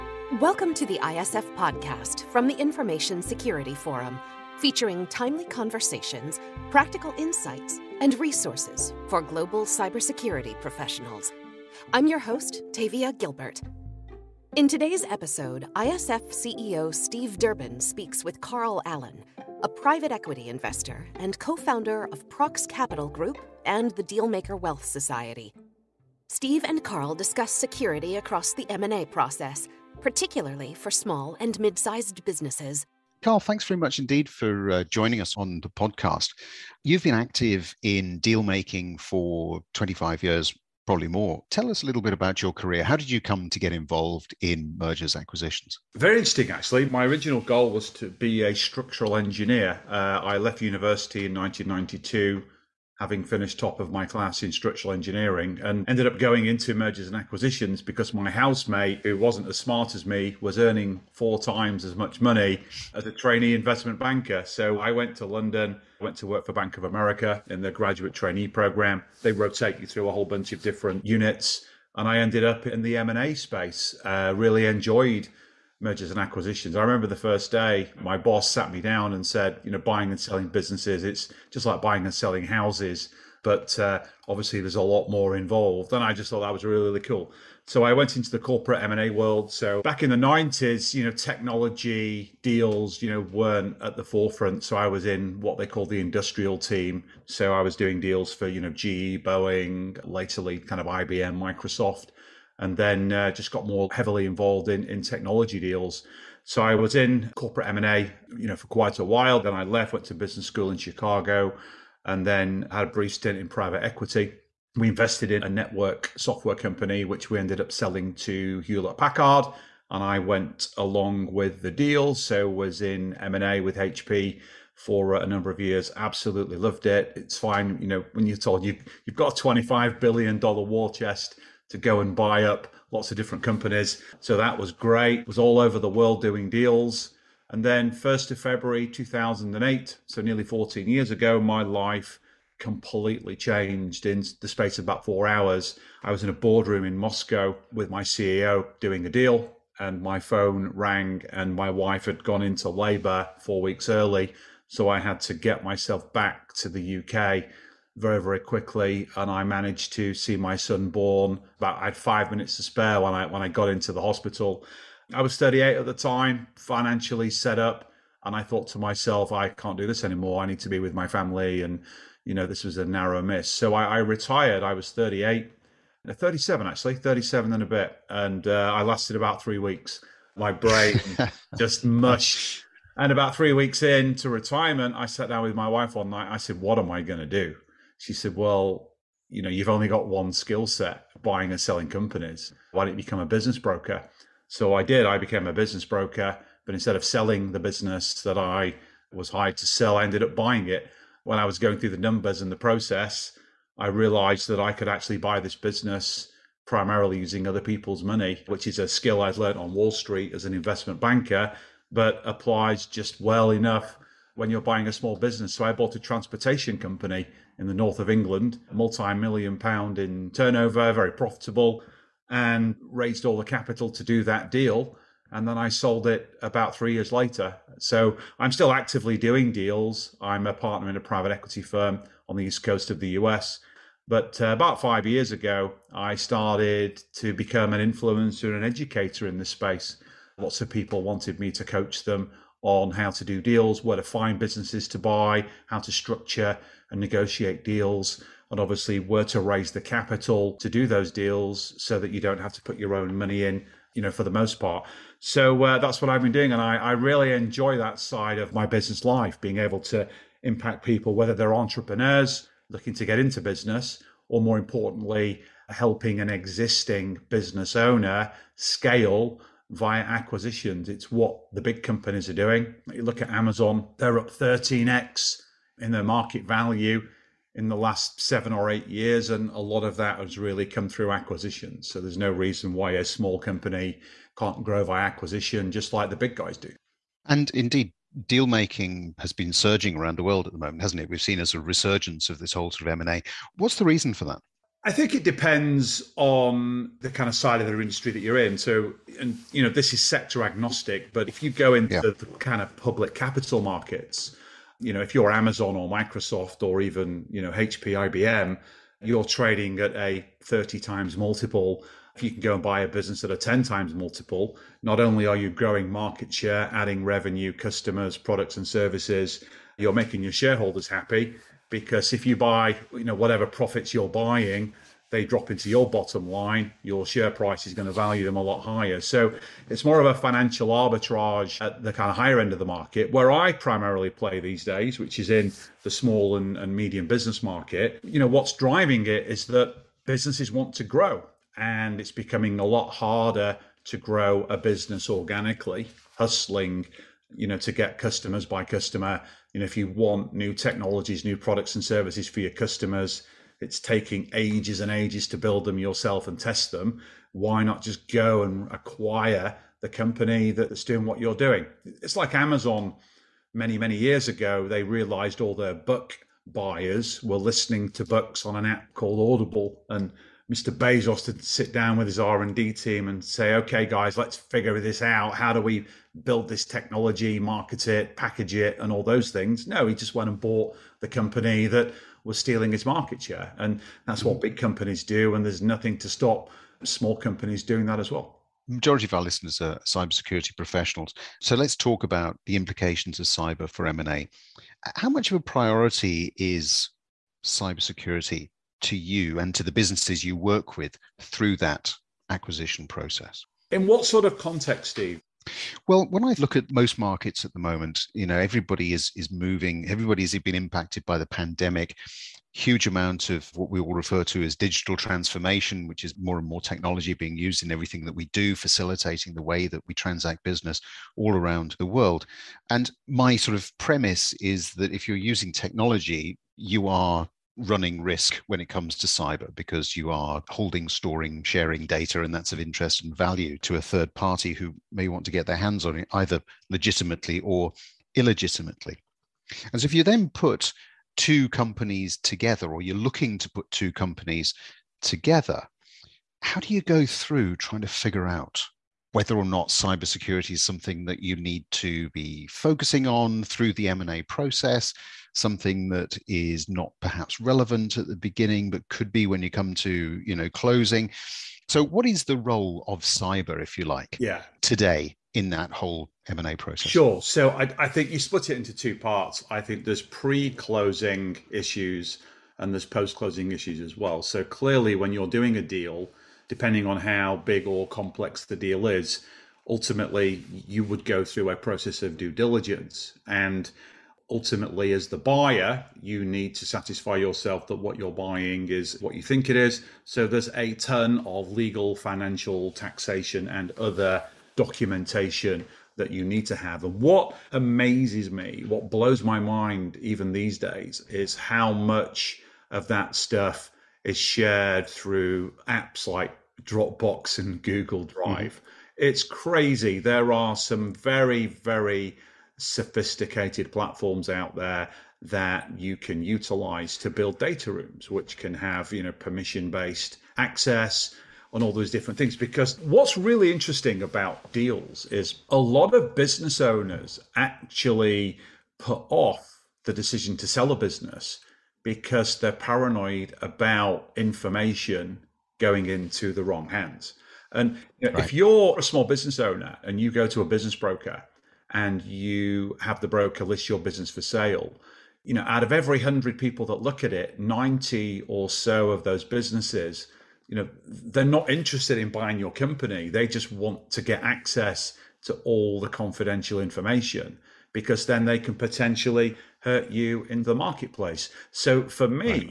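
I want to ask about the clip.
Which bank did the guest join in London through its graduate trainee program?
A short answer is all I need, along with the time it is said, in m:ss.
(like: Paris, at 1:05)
Bank of America, at 1:06.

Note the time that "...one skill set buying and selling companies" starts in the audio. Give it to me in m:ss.
3:10.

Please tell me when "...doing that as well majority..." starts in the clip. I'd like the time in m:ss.
6:27.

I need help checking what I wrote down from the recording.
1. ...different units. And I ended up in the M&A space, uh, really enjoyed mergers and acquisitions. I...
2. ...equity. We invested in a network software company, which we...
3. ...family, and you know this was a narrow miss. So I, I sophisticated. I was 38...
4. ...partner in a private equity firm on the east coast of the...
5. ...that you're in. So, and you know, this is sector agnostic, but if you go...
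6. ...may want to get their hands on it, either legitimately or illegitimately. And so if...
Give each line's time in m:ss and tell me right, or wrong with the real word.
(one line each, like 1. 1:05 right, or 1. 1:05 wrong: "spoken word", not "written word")
1. 1:10 right
2. 1:53 right
3. 2:51 wrong: "retired", not "sophisticated"
4. 3:50 right
5. 4:58 right
6. 7:14 right.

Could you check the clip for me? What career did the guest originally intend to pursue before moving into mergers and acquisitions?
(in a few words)
Structural engineer.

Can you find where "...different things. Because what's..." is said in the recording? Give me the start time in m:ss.
8:41.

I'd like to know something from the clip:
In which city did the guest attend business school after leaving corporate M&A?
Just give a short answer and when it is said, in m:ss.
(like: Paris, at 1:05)
Chicago, at 1:50.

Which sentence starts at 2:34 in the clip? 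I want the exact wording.
So I had to get myself back to the UK very, very quickly, and I managed to see my son born.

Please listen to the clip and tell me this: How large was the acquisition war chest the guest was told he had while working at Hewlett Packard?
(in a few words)
$25 billion.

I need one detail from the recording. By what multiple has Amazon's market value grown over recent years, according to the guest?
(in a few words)
13x.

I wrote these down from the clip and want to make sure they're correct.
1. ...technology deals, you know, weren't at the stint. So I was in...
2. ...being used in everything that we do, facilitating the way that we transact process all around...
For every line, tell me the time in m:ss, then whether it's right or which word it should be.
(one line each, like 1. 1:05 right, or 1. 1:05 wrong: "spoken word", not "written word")
1. 1:31 wrong: "forefront", not "stint"
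2. 6:57 wrong: "business", not "process".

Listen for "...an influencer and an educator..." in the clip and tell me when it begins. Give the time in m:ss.
3:57.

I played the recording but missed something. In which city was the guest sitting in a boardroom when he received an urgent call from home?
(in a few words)
Moscow.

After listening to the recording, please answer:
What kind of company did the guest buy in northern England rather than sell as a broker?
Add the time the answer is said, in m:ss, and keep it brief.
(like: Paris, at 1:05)
Transportation company, at 3:35.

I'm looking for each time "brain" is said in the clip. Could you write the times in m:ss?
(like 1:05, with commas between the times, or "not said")
3:00.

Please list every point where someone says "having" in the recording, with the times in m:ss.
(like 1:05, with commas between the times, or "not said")
0:53.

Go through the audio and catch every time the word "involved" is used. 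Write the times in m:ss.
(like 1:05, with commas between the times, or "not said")
0:43, 1:25, 1:44.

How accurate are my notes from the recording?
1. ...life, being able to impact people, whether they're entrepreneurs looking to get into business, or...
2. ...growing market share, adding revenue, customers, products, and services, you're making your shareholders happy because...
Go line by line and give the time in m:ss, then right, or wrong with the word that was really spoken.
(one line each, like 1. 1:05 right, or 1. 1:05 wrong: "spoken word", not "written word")
1. 4:19 right
2. 5:15 right.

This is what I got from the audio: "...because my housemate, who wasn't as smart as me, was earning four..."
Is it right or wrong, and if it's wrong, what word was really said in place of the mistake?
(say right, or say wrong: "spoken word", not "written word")
right.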